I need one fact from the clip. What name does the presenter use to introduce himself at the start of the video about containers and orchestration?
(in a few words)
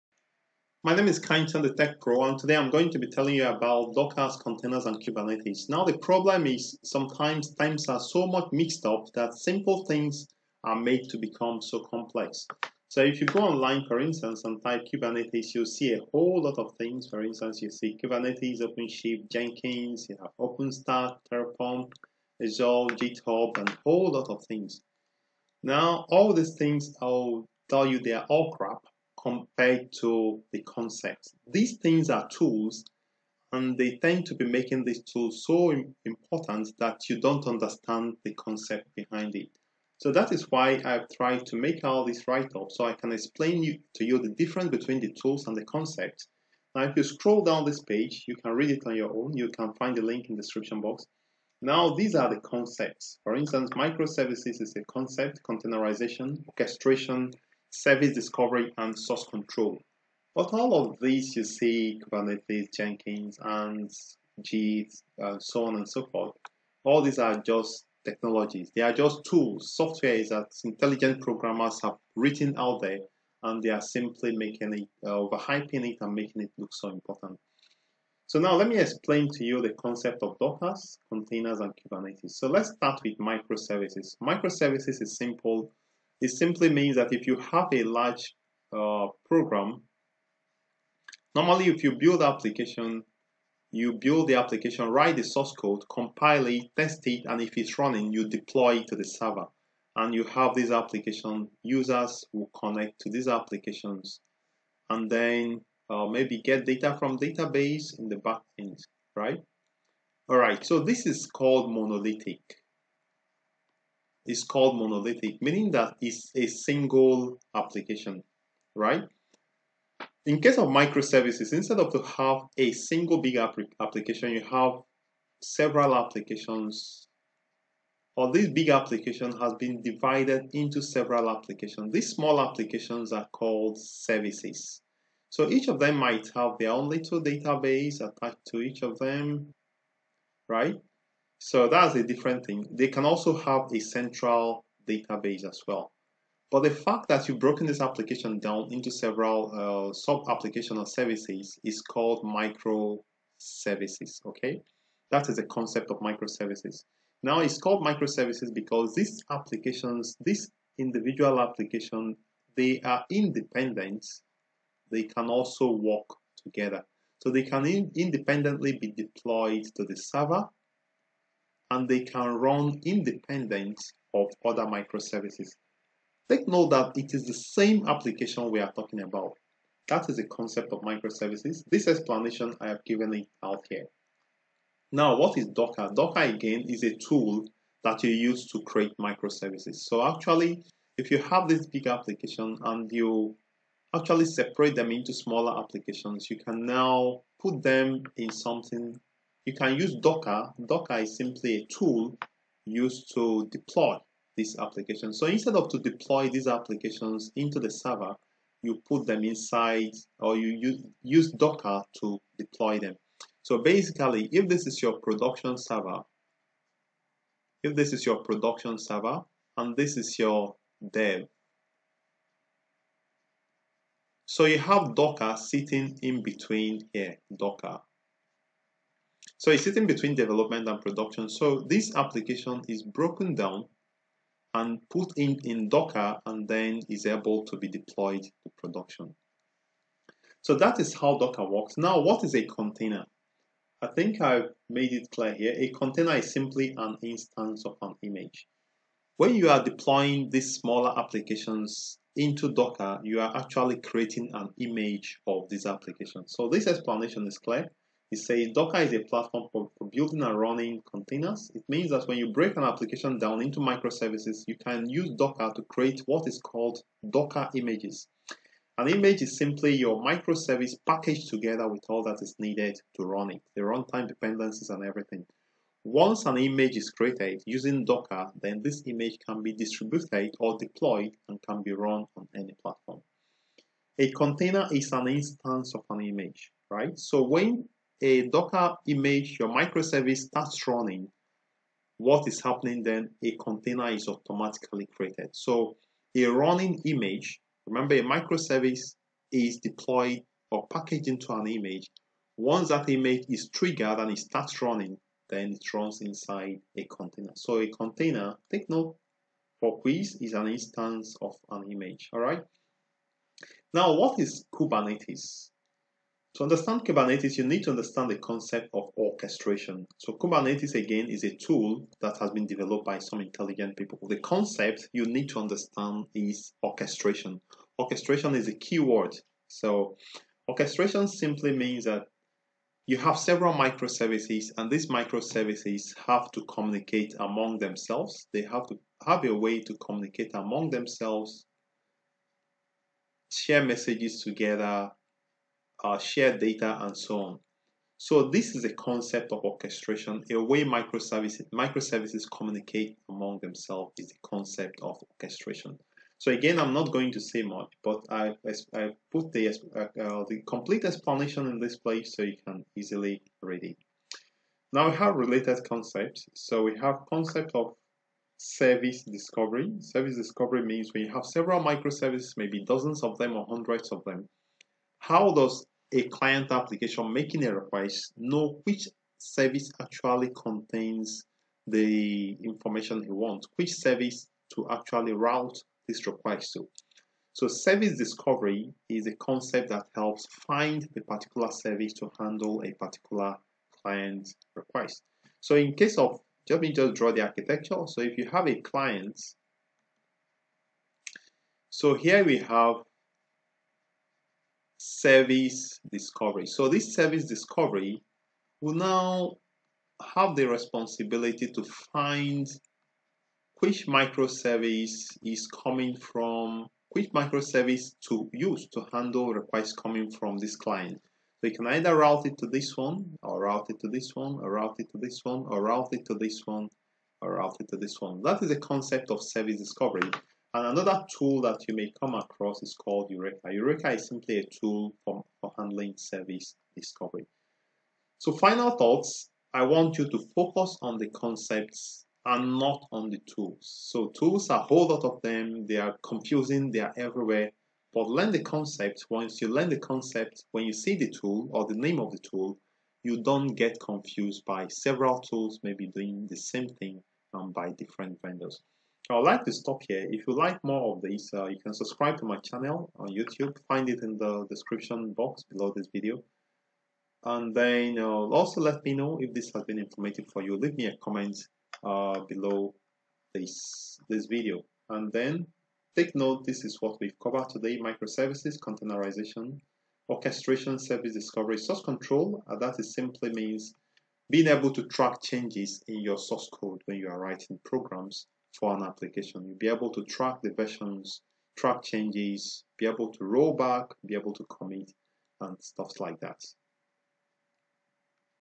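Kindson the Tech Pro.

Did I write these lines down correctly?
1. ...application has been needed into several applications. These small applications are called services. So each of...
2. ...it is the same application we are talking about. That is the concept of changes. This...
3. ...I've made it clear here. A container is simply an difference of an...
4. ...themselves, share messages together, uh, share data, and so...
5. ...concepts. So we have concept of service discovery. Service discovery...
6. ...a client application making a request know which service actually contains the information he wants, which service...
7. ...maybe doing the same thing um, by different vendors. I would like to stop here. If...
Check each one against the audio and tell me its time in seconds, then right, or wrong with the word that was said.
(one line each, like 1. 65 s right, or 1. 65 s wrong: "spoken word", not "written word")
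1. 128 s wrong: "divided", not "needed"
2. 176 s wrong: "microservices", not "changes"
3. 244 s wrong: "instance", not "difference"
4. 340 s right
5. 365 s right
6. 375 s right
7. 455 s right.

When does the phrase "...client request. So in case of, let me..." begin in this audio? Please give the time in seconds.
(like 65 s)
393 s.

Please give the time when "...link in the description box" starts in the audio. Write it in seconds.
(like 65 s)
50 s.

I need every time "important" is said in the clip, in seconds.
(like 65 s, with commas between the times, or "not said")
36 s, 76 s.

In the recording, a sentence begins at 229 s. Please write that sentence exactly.
So it's sitting between development and production.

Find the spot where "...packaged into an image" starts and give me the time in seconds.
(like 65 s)
300 s.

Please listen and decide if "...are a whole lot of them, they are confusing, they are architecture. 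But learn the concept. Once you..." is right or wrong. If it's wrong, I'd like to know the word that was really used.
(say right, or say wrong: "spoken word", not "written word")
wrong: "everywhere", not "architecture".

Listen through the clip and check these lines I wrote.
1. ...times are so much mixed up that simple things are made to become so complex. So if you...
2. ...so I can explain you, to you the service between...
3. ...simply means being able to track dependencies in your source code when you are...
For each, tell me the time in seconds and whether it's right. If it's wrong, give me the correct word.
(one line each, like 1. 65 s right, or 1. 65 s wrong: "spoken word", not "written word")
1. 7 s right
2. 42 s wrong: "difference", not "service"
3. 482 s wrong: "changes", not "dependencies".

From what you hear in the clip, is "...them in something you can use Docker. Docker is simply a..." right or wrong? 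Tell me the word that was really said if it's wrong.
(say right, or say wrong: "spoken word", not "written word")
right.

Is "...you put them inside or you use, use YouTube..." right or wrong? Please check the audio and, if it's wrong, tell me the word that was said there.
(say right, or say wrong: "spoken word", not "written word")
wrong: "Docker", not "YouTube".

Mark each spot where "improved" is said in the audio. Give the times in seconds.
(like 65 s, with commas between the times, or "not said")
not said.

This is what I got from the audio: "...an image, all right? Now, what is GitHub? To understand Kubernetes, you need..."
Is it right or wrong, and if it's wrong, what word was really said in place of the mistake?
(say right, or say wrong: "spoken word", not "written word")
wrong: "Kubernetes", not "GitHub".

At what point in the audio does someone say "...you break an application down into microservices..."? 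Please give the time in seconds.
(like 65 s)
262 s.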